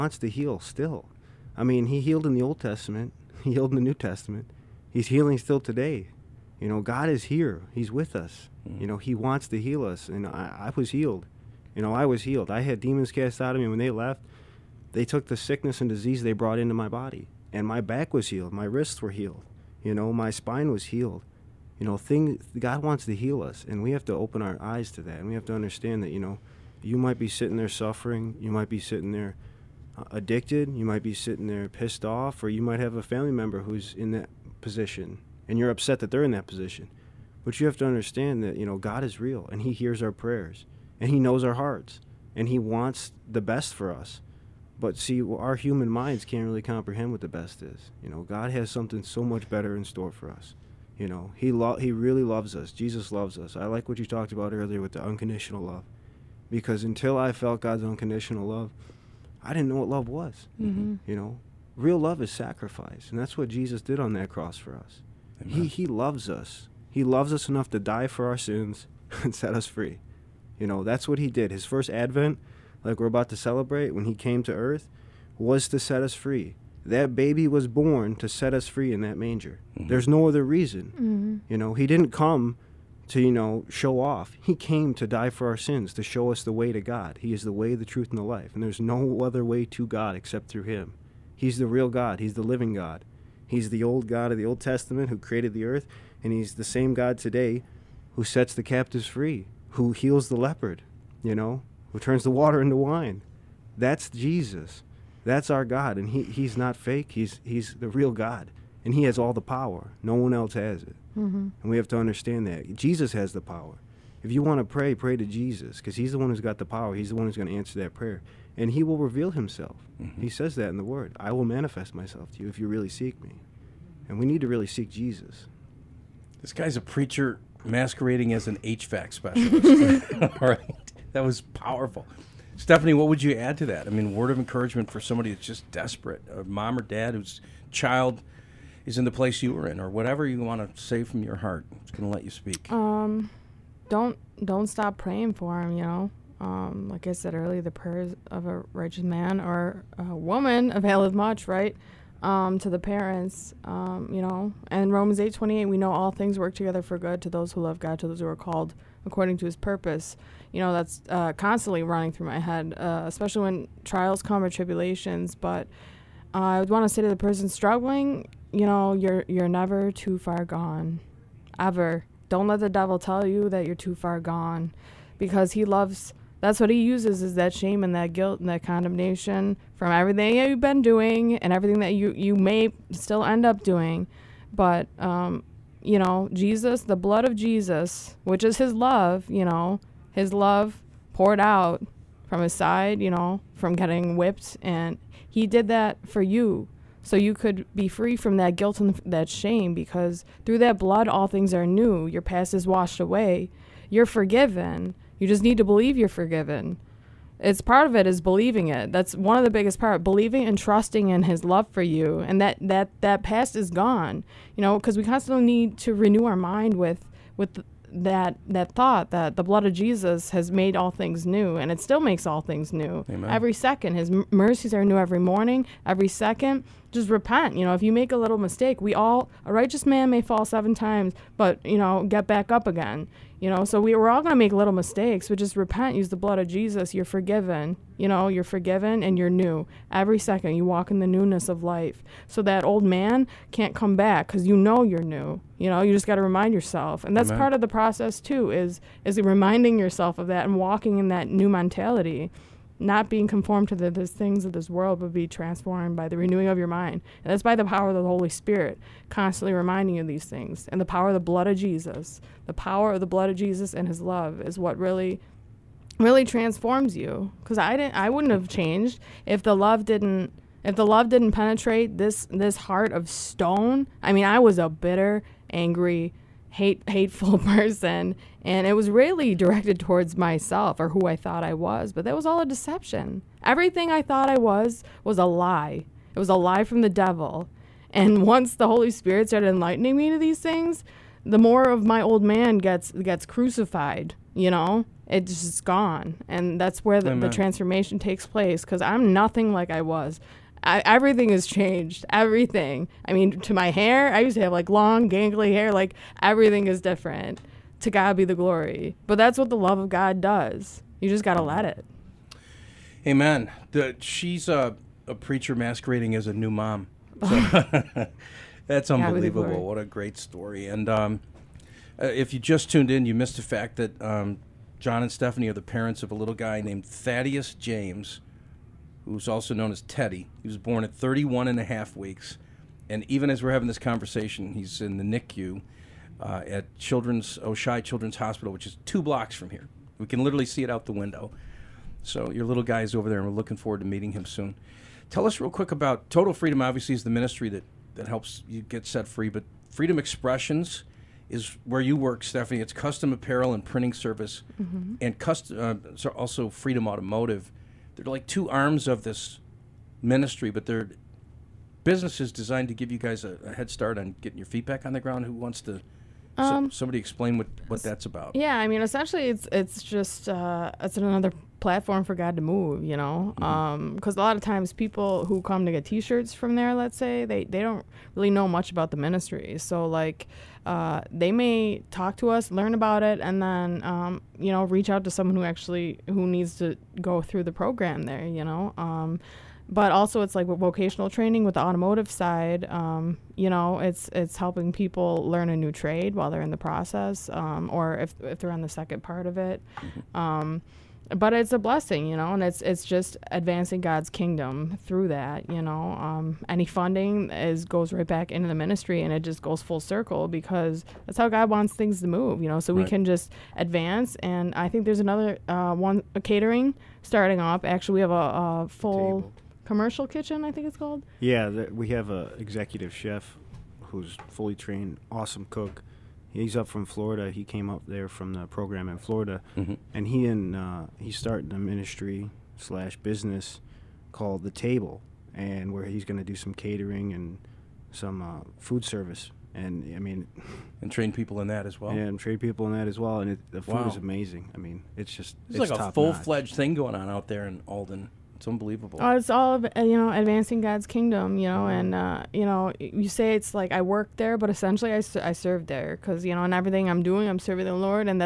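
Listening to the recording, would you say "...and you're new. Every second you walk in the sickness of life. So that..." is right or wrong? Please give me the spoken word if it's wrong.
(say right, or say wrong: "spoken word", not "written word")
wrong: "newness", not "sickness".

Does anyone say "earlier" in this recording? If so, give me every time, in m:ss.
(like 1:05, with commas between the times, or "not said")
0:54, 2:27.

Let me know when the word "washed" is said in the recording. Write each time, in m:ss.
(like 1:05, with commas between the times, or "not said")
3:22.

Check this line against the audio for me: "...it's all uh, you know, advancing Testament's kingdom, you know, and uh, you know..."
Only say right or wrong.
wrong.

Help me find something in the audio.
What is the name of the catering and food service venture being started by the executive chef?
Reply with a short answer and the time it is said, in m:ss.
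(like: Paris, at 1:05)
The Table, at 7:14.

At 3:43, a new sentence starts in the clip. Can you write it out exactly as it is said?
every second his mercies are new every morning every second just repent.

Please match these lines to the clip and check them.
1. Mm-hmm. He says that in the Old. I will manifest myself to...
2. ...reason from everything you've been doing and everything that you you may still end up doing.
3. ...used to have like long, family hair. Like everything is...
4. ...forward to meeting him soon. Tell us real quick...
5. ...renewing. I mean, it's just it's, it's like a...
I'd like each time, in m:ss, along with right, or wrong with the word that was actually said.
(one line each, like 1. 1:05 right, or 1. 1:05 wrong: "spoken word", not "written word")
1. 2:00 wrong: "Word", not "Old"
2. 2:58 wrong: "condemnation", not "reason"
3. 5:04 wrong: "gangly", not "family"
4. 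5:43 right
5. 7:23 wrong: "amazing", not "renewing".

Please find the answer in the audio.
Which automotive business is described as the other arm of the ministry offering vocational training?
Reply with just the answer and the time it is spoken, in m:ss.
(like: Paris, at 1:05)
Freedom Automotive, at 5:56.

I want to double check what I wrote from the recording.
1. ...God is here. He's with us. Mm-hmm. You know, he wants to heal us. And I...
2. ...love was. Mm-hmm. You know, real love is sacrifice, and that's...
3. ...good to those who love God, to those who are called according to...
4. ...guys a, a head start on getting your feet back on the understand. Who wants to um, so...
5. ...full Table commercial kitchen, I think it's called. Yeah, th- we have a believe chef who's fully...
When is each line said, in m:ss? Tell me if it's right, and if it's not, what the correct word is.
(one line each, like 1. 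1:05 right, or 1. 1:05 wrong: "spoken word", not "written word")
1. 0:06 right
2. 0:59 right
3. 2:36 right
4. 6:02 wrong: "ground", not "understand"
5. 6:58 wrong: "executive", not "believe".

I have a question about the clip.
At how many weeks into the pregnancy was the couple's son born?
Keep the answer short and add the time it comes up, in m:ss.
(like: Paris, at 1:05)
31 and a half weeks, at 5:30.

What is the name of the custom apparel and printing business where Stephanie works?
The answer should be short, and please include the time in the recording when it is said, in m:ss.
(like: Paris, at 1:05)
Freedom Expressions, at 5:49.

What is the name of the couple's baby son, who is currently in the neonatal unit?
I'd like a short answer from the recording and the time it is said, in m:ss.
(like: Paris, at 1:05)
Thaddeus James, at 5:26.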